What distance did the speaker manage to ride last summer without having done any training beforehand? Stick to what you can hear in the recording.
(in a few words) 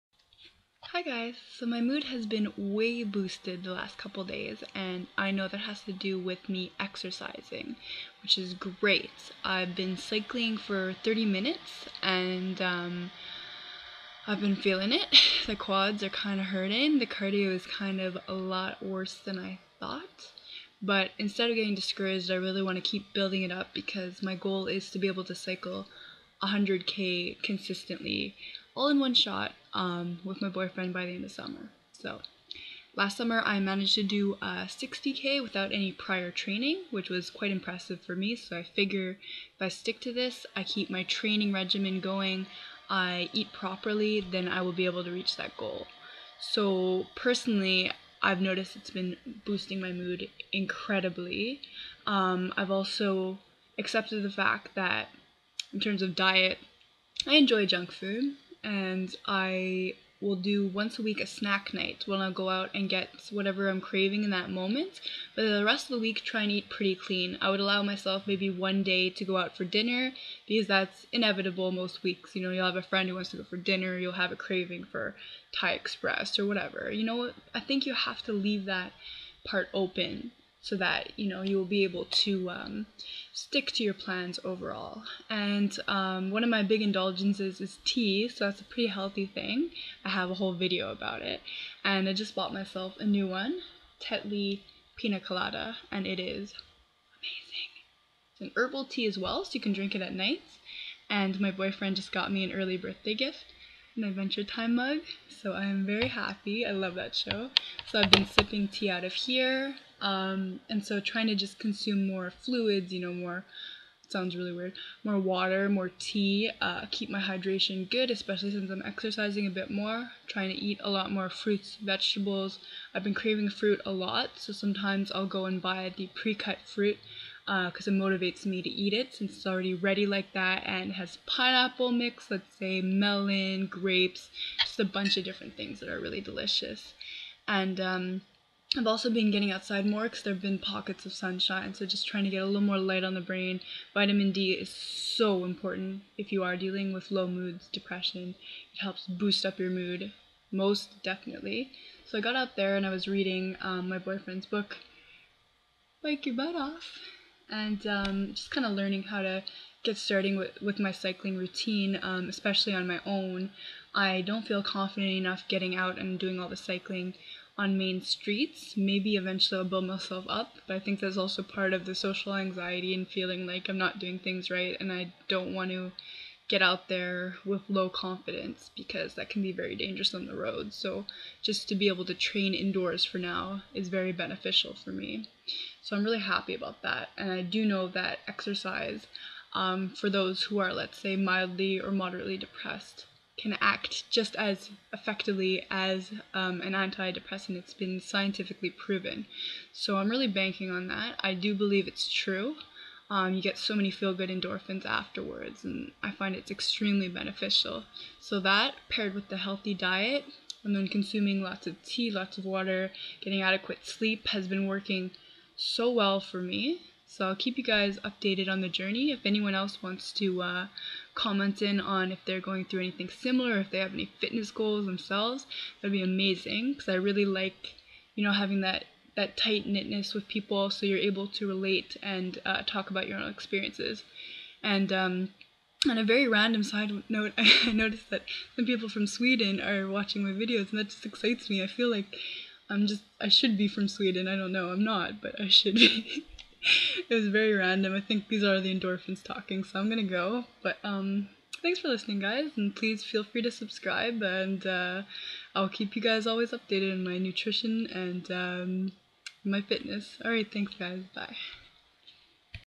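60k.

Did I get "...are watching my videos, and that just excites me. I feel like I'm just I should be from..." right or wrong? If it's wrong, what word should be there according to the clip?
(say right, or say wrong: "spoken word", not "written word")
right.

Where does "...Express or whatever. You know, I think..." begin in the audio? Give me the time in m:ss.
1:15.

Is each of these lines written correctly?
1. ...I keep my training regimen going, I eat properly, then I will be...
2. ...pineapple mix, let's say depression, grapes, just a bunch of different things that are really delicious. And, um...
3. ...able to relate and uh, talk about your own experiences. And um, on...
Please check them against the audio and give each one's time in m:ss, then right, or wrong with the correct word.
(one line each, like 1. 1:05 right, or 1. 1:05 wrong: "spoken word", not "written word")
1. 0:40 right
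2. 2:11 wrong: "melon", not "depression"
3. 3:50 right.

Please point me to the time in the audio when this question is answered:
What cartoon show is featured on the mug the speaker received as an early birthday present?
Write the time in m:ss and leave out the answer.
1:44.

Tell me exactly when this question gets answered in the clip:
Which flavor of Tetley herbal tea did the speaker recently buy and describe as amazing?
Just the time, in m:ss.
1:34.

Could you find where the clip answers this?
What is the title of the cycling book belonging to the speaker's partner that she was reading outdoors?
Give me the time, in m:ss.
2:36.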